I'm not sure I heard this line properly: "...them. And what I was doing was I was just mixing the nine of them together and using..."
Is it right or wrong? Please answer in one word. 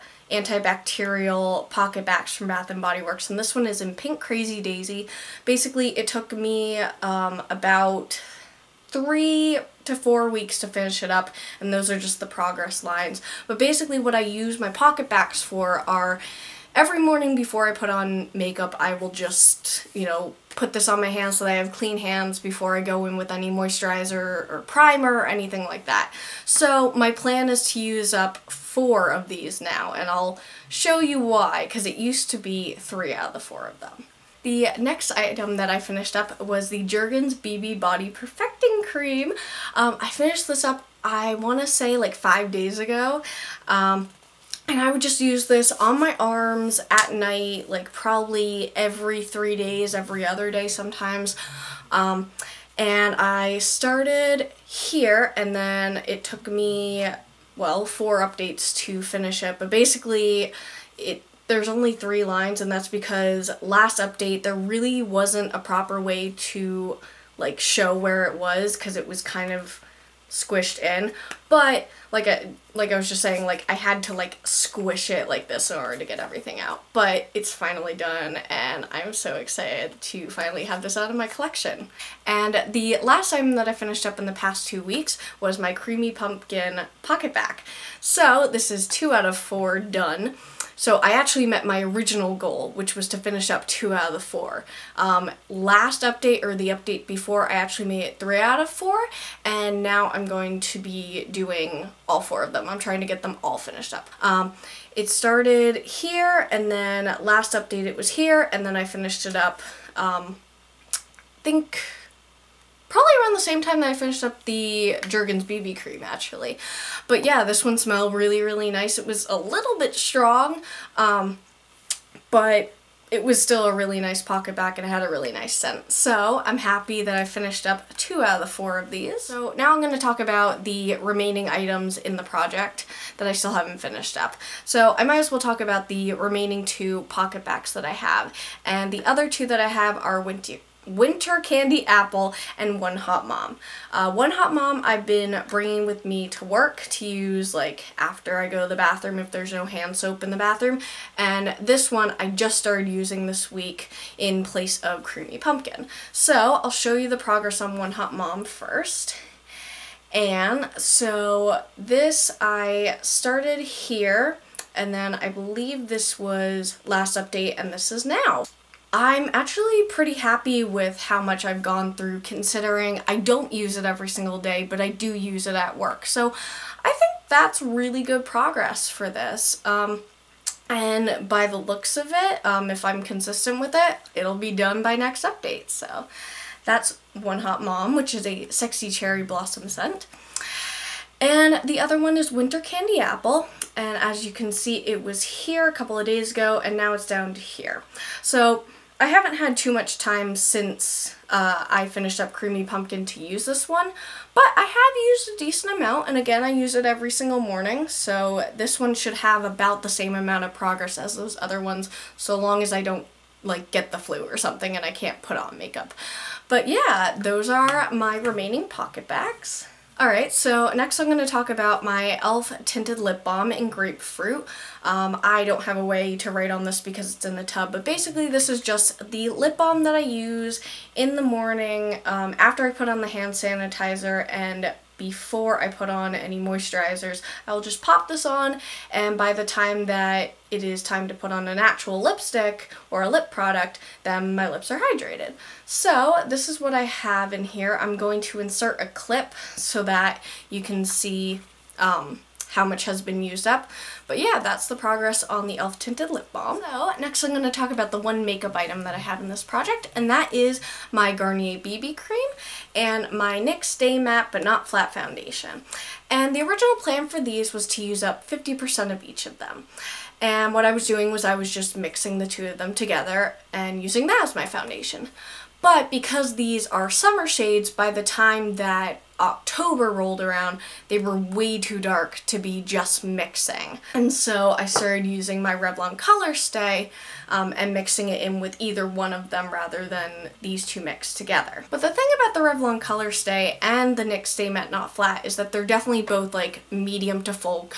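wrong.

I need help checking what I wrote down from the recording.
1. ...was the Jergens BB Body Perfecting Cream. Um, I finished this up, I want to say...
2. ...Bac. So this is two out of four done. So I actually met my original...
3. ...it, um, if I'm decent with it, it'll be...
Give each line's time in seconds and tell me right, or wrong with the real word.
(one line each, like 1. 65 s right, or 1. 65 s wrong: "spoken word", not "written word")
1. 36 s right
2. 87 s right
3. 182 s wrong: "consistent", not "decent".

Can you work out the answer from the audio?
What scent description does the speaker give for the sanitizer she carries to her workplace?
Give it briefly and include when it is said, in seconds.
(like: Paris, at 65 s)
sexy cherry blossom, at 188 s.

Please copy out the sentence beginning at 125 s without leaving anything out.
So I'm happy that I finished up two out of the four of these.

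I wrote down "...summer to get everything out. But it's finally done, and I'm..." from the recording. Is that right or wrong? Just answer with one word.
wrong.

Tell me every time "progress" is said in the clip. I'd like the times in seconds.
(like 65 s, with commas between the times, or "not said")
12 s, 157 s, 178 s, 210 s, 254 s.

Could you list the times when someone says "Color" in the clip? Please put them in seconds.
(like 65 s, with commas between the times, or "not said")
285 s, 292 s.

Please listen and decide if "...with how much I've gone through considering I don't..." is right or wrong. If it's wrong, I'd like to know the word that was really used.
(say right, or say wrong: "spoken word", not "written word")
right.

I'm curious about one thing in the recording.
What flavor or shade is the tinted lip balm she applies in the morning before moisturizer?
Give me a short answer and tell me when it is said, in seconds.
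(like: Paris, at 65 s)
Grapefruit, at 223 s.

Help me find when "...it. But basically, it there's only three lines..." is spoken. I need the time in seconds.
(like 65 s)
59 s.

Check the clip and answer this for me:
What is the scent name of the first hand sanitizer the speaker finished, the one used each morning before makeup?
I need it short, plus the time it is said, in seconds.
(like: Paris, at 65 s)
Pink Crazy Daisy, at 3 s.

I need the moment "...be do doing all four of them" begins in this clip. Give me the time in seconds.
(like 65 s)
100 s.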